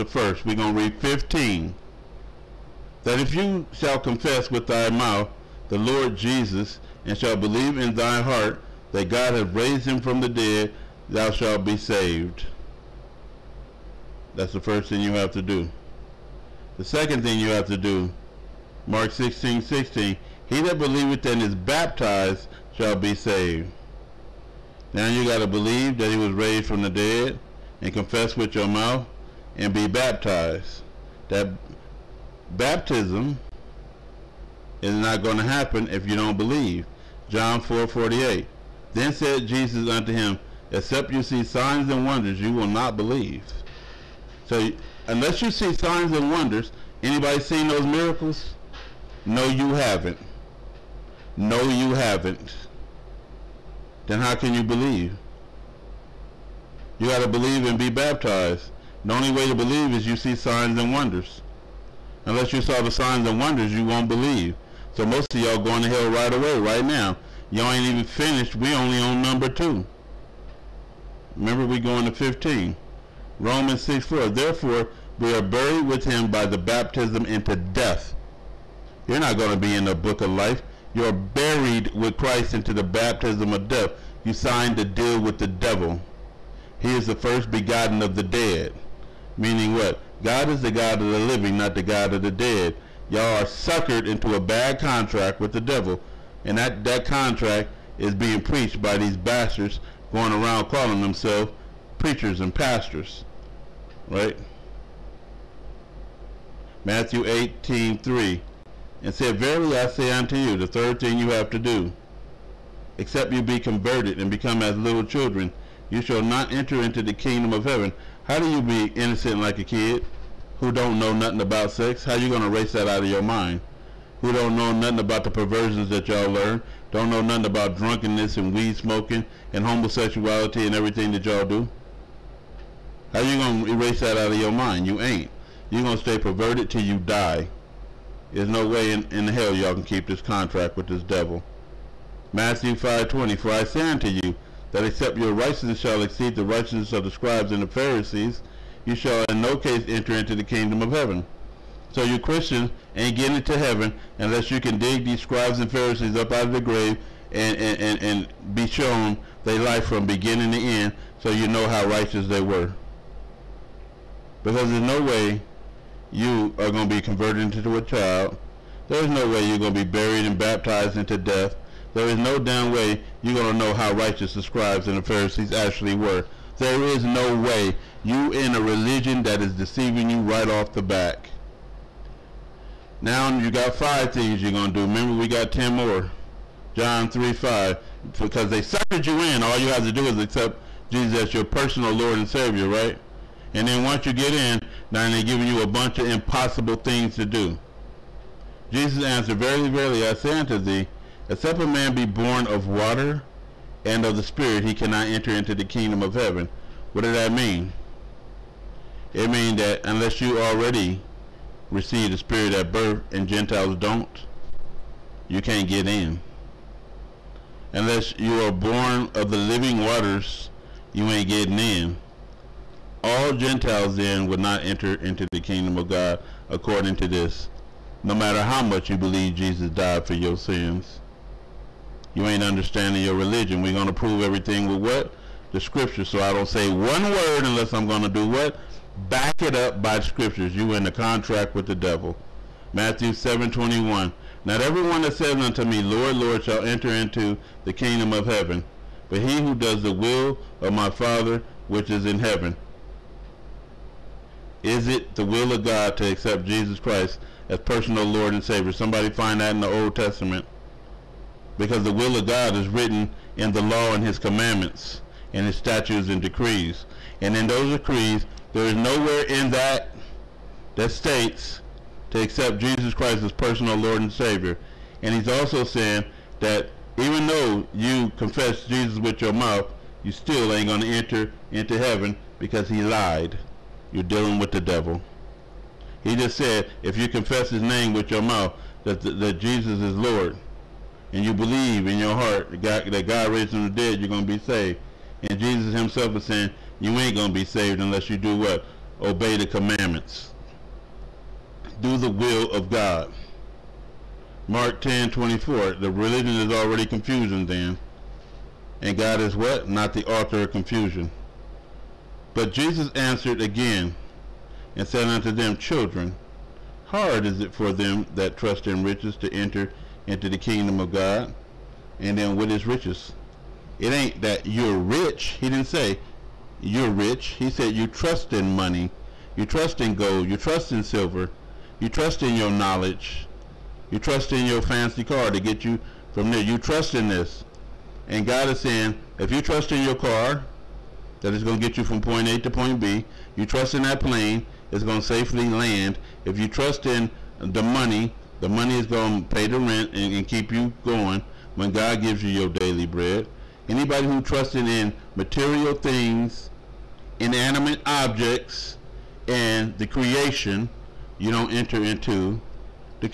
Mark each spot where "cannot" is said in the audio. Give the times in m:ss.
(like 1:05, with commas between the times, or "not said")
3:24.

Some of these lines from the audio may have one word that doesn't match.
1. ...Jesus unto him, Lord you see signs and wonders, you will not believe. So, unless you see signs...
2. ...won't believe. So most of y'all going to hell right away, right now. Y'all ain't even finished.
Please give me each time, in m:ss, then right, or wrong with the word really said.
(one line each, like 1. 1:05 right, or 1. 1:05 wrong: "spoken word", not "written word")
1. 0:39 wrong: "Except", not "Lord"
2. 1:03 right.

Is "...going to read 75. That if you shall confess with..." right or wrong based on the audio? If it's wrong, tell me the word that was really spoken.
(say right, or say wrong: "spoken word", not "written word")
wrong: "15", not "75".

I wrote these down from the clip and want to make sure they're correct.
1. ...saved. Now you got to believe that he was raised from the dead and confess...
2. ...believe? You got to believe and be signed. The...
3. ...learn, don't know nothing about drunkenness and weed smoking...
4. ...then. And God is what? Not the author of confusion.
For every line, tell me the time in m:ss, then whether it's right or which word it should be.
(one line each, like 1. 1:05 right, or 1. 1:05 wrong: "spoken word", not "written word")
1. 0:23 right
2. 0:54 wrong: "baptized", not "signed"
3. 2:06 right
4. 5:07 right.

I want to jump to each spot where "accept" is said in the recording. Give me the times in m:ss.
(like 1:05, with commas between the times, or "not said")
3:10, 4:16, 4:32.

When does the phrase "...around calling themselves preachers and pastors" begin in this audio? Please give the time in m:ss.
1:40.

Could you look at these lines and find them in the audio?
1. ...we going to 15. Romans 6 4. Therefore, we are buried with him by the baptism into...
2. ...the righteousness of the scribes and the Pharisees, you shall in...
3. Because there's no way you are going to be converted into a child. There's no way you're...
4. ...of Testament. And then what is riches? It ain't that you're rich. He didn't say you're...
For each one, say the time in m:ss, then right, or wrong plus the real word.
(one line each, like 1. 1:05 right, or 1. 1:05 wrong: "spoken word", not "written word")
1. 1:11 right
2. 2:26 right
3. 2:44 right
4. 5:20 wrong: "God", not "Testament".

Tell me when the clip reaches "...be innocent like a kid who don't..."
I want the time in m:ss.
1:58.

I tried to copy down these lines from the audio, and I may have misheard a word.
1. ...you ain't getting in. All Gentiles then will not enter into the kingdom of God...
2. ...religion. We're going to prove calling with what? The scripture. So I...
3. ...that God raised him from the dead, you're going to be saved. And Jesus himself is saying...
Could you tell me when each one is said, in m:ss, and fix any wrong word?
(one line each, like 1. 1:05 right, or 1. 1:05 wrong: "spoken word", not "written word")
1. 3:40 right
2. 3:53 wrong: "everything", not "calling"
3. 4:52 right.